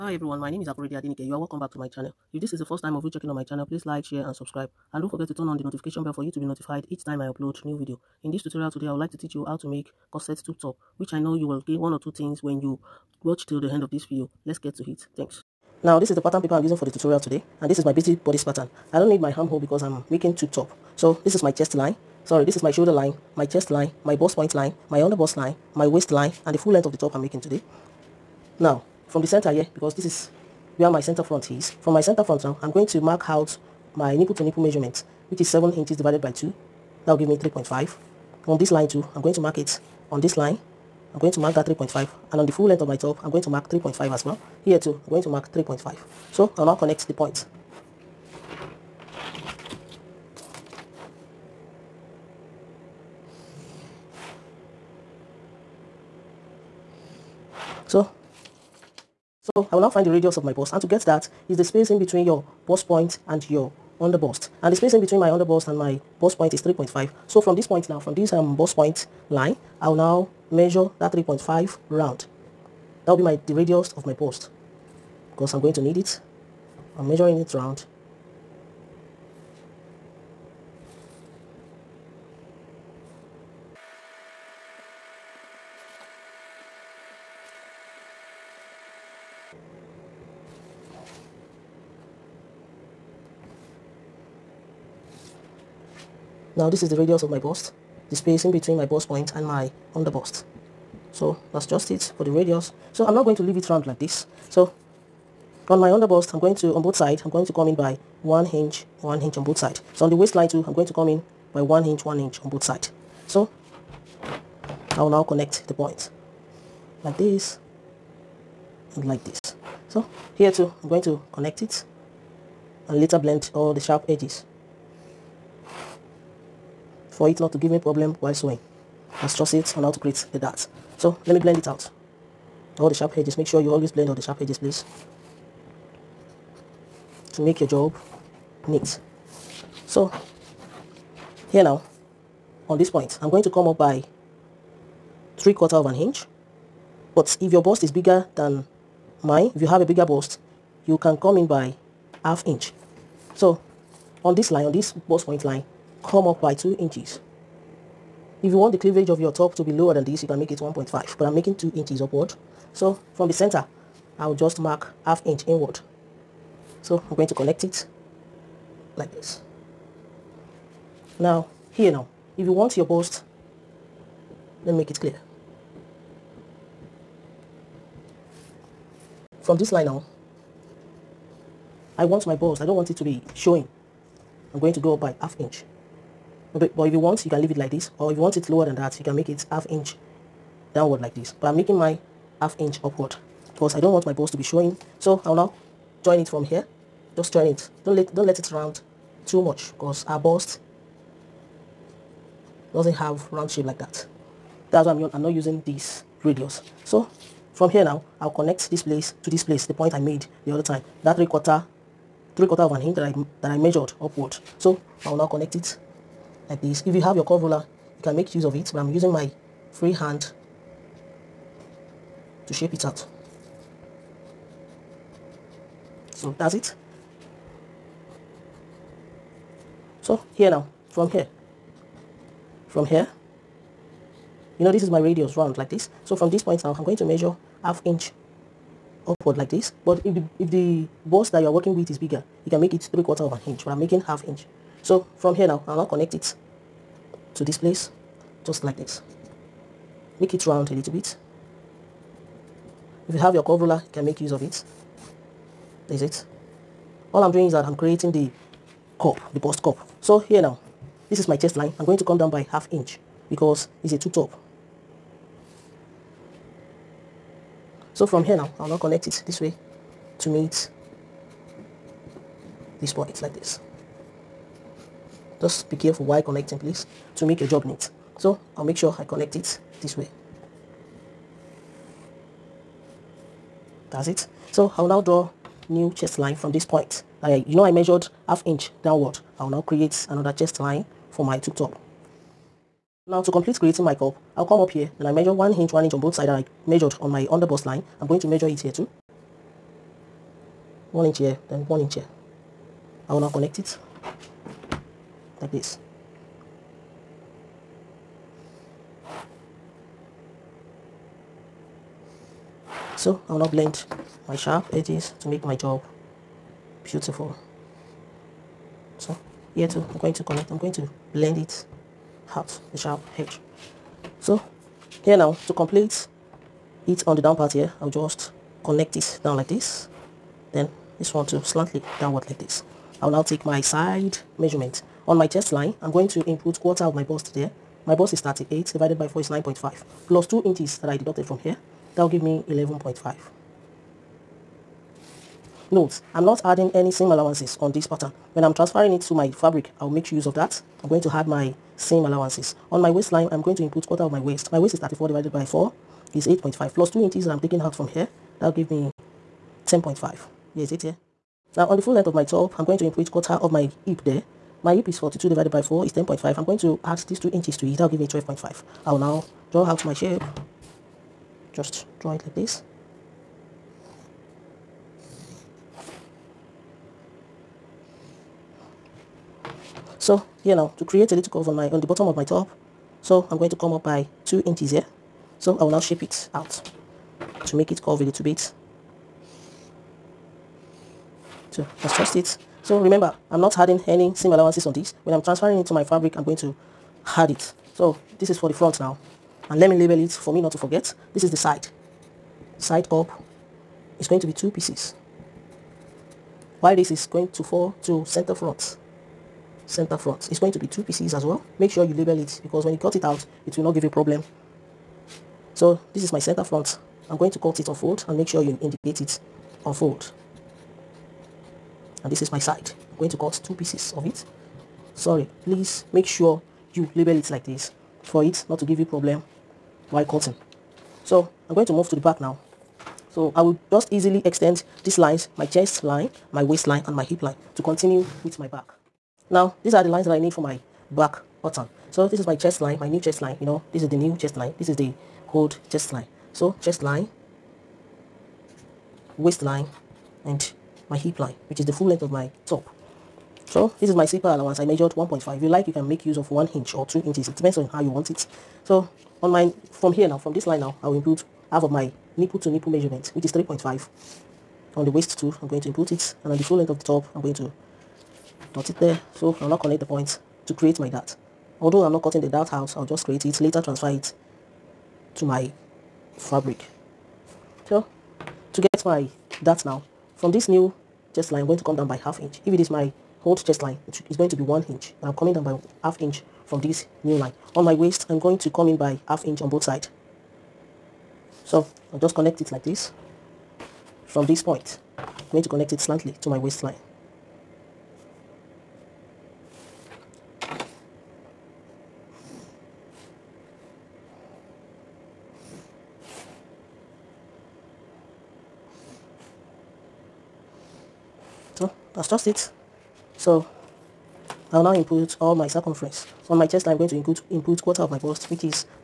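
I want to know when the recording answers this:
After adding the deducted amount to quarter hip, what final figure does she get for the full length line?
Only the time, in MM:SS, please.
06:08.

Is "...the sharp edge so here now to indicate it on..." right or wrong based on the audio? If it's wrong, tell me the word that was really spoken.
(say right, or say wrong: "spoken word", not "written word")
wrong: "complete", not "indicate".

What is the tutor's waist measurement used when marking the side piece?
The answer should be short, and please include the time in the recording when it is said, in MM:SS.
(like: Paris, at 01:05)
34, at 05:54.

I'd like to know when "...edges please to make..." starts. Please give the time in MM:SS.
02:14.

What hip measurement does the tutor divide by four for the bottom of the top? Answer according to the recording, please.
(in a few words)
42.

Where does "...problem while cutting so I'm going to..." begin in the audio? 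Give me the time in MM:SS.
07:08.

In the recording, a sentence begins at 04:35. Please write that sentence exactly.
Just be careful while connecting please to make your job neat.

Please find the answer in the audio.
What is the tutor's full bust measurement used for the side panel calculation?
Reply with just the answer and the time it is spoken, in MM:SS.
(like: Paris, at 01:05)
38, at 05:38.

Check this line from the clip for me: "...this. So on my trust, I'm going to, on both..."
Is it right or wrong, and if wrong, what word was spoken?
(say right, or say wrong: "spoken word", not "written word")
wrong: "underbust", not "trust".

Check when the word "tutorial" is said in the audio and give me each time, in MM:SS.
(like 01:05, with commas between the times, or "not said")
00:08, 00:16.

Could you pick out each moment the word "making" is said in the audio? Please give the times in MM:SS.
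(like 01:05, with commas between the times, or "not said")
00:20, 00:27, 02:41, 03:11, 04:03.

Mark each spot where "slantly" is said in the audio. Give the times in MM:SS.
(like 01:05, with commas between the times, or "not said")
05:31, 08:15.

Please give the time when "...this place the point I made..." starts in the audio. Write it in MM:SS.
03:29.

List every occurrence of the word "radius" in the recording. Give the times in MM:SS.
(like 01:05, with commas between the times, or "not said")
01:00, 01:13, 01:36, 01:42, 03:26, 03:54.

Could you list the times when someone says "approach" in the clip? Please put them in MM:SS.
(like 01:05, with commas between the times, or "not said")
not said.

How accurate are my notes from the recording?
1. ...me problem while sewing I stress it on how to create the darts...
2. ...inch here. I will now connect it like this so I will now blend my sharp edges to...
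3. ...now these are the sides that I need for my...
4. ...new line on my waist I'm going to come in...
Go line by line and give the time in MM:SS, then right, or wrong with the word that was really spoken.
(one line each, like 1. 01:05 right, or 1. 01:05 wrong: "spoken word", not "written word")
1. 02:07 right
2. 05:01 right
3. 07:19 wrong: "lines", not "sides"
4. 08:07 right.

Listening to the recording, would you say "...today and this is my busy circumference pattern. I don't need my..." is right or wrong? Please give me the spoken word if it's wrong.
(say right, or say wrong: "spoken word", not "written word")
wrong: "bodice", not "circumference".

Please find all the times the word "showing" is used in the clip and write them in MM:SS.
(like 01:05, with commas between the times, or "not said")
03:03, 03:14.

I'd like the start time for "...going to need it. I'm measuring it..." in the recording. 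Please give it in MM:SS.
01:15.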